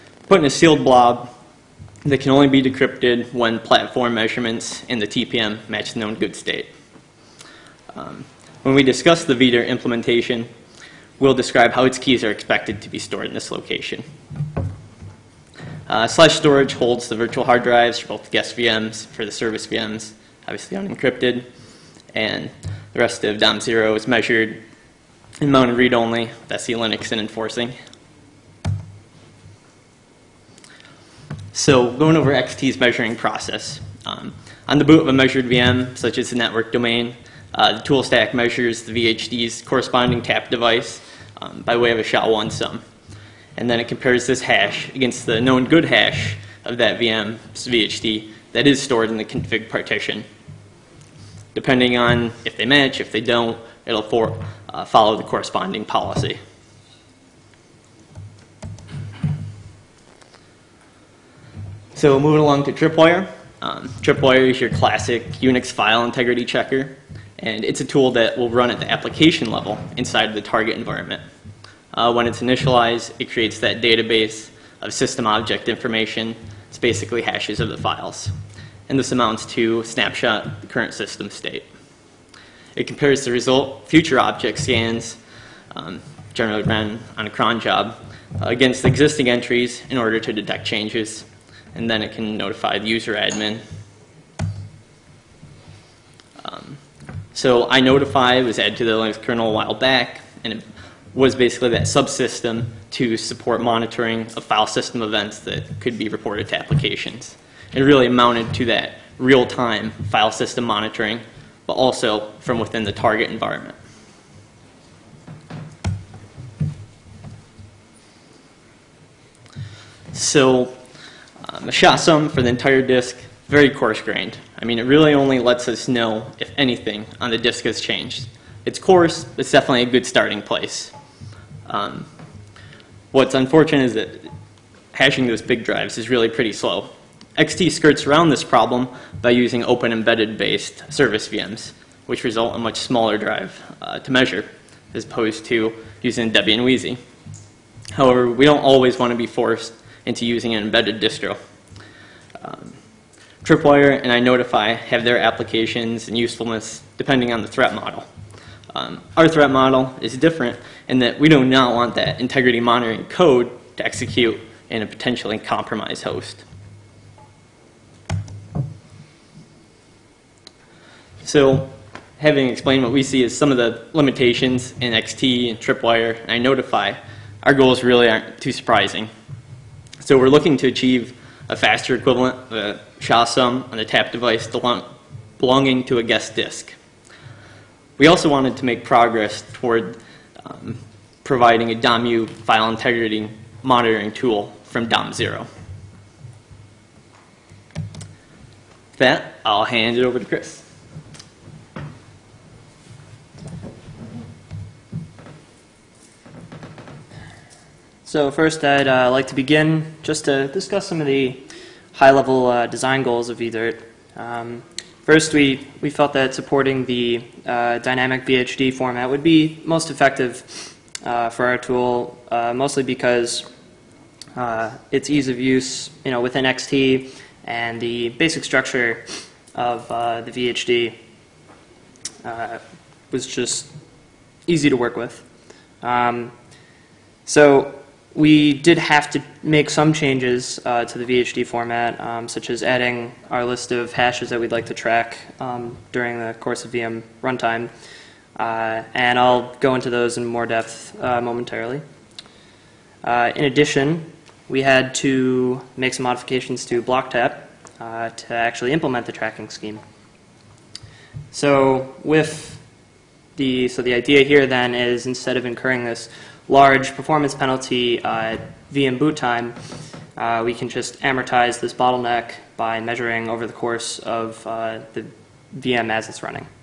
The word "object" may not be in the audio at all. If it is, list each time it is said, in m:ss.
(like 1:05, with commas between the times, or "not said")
1:15, 1:24.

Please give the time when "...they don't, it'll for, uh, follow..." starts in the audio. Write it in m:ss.
0:53.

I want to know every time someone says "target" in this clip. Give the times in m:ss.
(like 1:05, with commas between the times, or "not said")
1:10, 1:52.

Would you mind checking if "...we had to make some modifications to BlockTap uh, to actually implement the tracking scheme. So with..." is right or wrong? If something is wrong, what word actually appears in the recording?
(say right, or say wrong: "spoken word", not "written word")
right.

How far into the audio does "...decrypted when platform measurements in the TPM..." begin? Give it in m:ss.
0:02.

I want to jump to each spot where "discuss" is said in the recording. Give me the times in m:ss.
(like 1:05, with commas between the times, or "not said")
0:08, 3:30.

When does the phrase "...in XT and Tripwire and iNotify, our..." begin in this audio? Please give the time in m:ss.
2:54.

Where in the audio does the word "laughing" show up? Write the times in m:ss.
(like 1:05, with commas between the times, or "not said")
not said.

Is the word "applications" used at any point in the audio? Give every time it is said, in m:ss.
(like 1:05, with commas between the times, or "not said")
1:08, 1:46, 2:35.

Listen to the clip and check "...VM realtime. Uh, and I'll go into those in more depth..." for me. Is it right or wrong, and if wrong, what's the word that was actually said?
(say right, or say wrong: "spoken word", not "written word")
wrong: "runtime", not "realtime".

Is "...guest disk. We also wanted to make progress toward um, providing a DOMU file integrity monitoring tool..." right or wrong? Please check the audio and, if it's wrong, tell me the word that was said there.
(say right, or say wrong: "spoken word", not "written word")
right.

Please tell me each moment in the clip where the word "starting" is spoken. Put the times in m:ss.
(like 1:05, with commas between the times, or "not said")
2:10.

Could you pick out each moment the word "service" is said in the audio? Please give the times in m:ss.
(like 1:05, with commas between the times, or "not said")
0:19, 2:20.